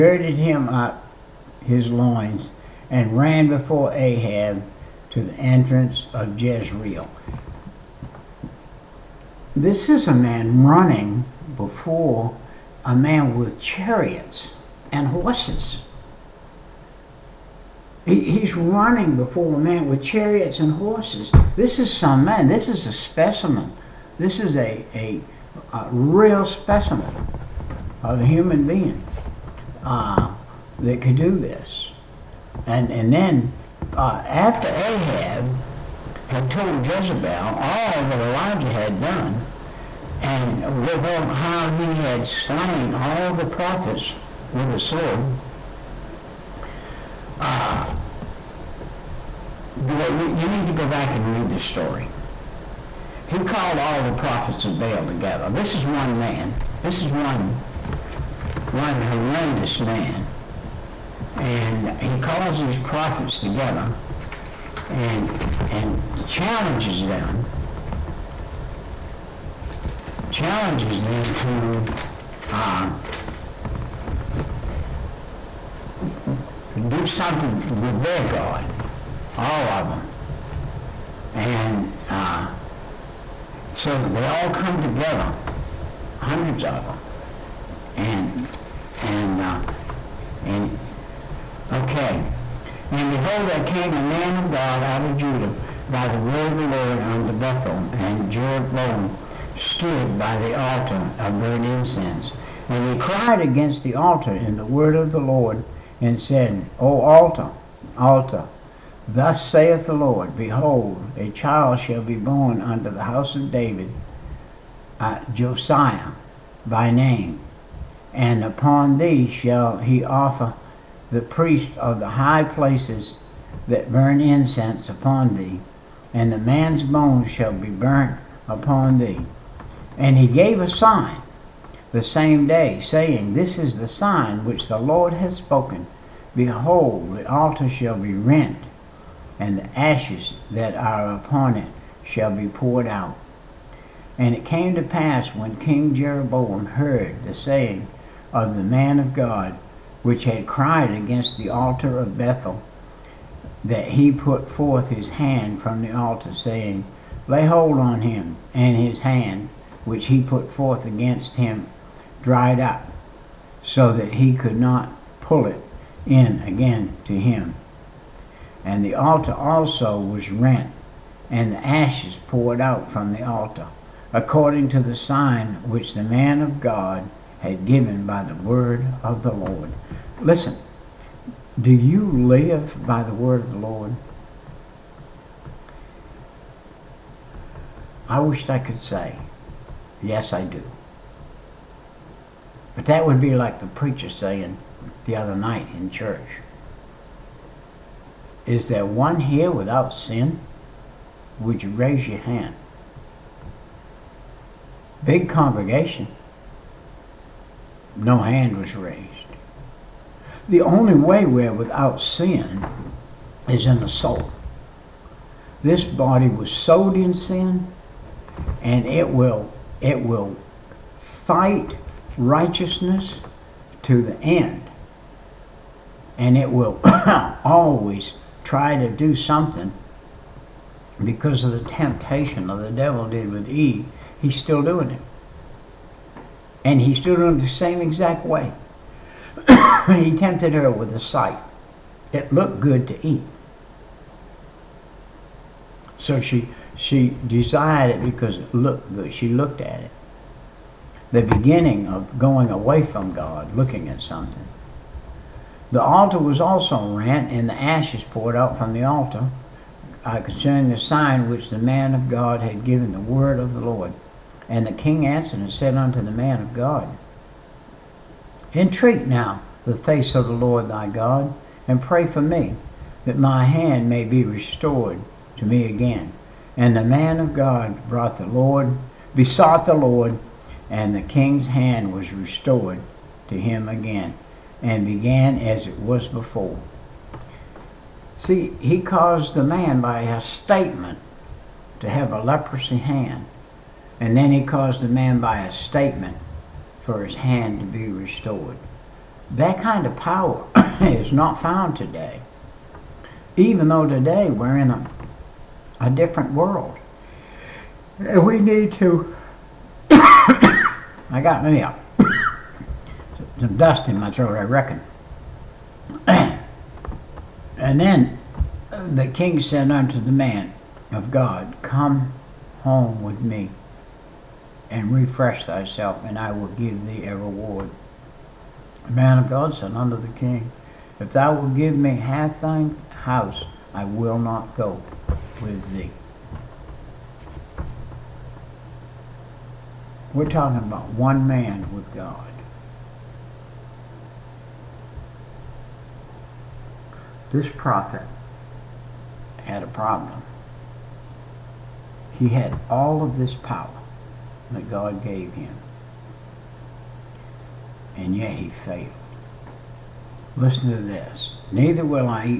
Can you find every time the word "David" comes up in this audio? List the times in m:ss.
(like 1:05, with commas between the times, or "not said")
1:53.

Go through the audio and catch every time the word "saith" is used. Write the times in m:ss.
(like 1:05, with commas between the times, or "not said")
1:49.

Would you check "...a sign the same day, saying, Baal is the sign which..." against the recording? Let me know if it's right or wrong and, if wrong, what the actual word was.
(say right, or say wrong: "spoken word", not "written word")
wrong: "This", not "Baal".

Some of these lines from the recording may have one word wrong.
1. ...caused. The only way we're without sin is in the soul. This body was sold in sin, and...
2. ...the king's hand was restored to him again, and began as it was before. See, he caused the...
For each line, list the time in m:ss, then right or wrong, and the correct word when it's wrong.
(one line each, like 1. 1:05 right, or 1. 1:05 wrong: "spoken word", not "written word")
1. 3:28 wrong: "raised", not "caused"
2. 4:40 right.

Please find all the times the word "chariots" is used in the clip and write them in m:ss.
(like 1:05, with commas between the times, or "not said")
0:13, 0:20.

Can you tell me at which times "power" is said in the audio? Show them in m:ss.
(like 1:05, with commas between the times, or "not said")
4:59, 5:53.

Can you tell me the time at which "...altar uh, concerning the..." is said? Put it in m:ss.
4:18.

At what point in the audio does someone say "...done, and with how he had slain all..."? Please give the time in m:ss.
0:38.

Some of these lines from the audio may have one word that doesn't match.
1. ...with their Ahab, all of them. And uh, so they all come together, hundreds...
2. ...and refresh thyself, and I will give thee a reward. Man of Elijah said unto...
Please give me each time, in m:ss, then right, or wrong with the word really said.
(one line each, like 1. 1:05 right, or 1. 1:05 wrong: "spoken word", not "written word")
1. 1:17 wrong: "God", not "Ahab"
2. 5:24 wrong: "God", not "Elijah".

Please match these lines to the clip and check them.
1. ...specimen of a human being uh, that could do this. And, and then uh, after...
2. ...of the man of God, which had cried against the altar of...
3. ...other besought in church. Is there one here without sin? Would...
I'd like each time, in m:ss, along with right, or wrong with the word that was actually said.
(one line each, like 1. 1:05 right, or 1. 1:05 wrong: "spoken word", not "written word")
1. 0:26 right
2. 2:28 right
3. 3:15 wrong: "night", not "besought".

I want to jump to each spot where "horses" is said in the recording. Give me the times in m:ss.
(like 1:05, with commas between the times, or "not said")
0:15, 0:20.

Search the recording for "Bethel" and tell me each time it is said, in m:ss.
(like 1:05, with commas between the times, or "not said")
1:37, 2:32.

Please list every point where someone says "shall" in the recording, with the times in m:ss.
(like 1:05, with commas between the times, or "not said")
1:51, 1:59, 2:07, 2:17, 2:22.